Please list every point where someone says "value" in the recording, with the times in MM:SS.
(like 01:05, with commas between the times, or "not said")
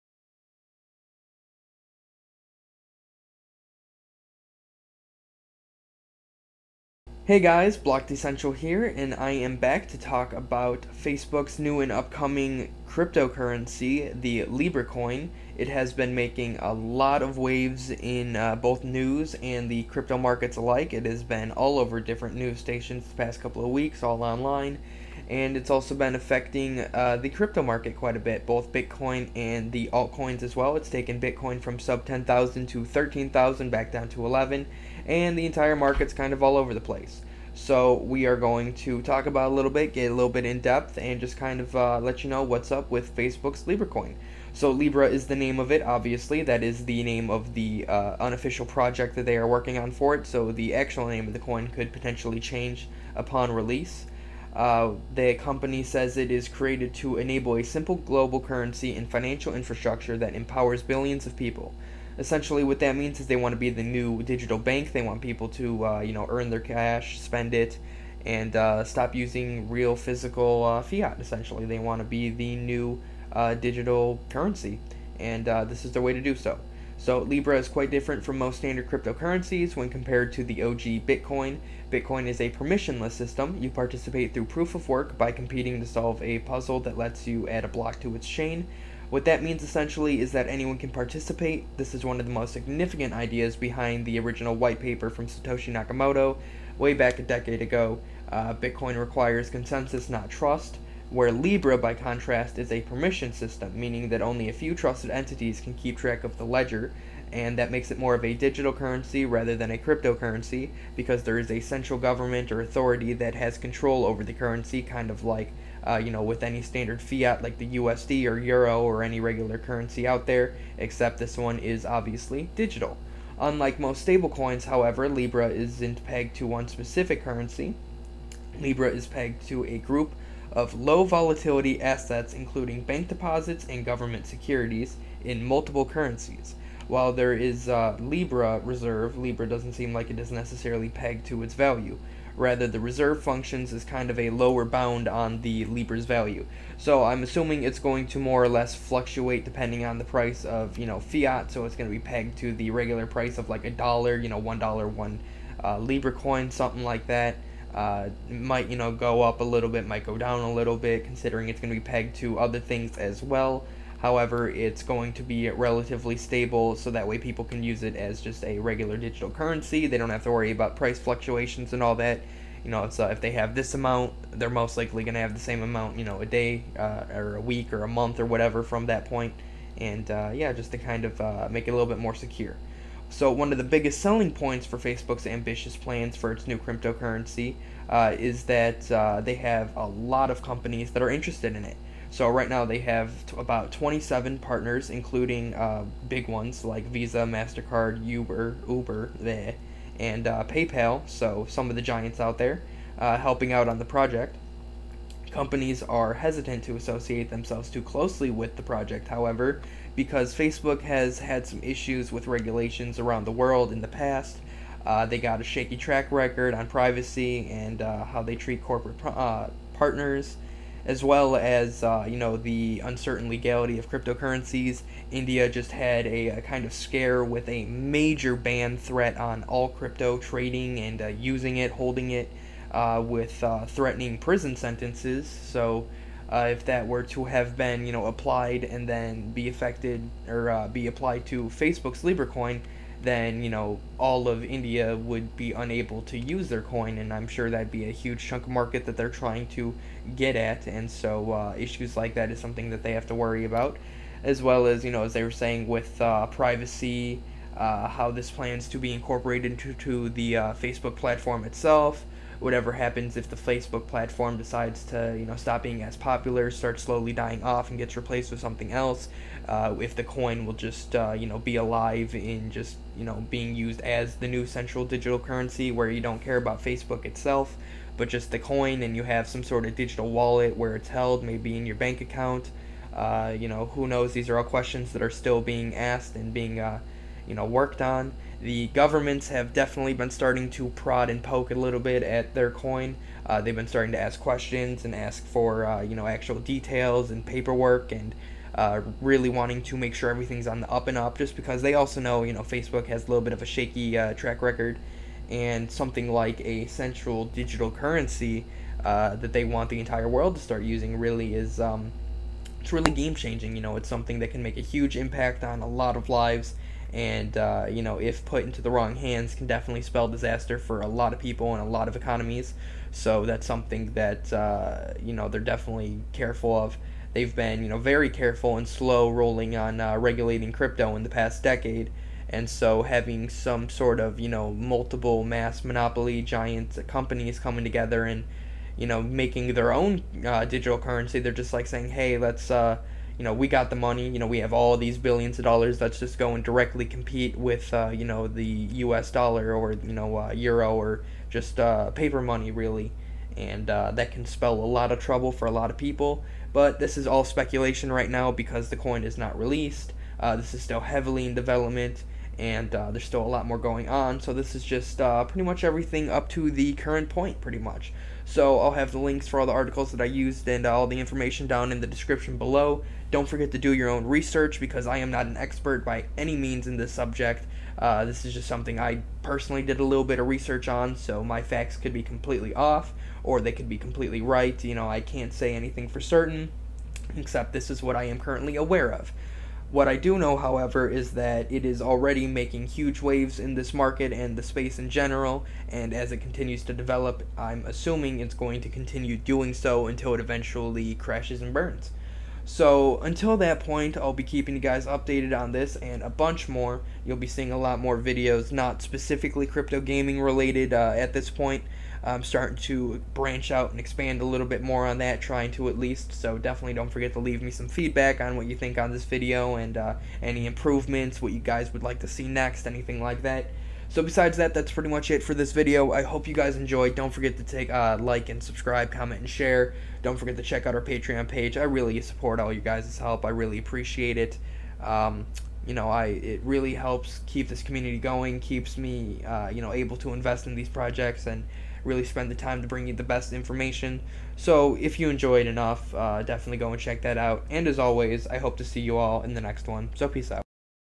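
02:21, 02:26.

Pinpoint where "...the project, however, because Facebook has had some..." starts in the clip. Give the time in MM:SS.
03:28.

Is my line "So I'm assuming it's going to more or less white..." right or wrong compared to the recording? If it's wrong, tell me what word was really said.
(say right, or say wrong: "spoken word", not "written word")
wrong: "fluctuate", not "white".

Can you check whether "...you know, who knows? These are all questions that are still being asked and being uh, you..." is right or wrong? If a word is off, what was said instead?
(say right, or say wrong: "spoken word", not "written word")
right.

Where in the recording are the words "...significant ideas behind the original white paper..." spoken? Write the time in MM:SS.
01:32.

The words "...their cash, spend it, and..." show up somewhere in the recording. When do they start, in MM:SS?
01:06.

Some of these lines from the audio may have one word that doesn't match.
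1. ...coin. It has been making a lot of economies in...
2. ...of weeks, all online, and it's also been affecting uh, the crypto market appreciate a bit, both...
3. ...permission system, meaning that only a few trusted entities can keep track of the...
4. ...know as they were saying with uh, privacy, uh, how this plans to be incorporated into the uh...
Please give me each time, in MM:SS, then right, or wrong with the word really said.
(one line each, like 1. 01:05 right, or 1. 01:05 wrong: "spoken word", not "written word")
1. 00:14 wrong: "waves", not "economies"
2. 00:23 wrong: "quite", not "appreciate"
3. 01:42 right
4. 04:14 right.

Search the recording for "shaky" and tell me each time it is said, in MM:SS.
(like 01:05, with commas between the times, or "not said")
03:35, 05:03.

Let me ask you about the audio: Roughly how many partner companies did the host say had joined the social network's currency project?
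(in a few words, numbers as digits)
27.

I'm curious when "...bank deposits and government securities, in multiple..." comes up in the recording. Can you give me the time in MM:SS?
02:12.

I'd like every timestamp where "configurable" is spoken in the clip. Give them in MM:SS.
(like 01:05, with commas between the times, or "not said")
not said.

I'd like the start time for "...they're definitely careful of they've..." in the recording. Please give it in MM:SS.
05:25.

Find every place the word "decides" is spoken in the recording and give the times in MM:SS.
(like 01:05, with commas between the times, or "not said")
04:24.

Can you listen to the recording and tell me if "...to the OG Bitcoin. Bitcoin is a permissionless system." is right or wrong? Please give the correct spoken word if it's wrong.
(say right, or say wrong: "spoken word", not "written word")
right.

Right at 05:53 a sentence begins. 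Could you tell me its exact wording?
And uh, that can spell a lot of trouble for a lot of people.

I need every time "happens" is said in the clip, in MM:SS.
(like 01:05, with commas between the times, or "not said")
04:22.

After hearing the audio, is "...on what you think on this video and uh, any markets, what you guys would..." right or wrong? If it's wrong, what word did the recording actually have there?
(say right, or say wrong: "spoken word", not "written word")
wrong: "improvements", not "markets".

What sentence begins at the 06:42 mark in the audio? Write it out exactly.
So, until that point, I'll be keeping you guys updated on this and a bunch more.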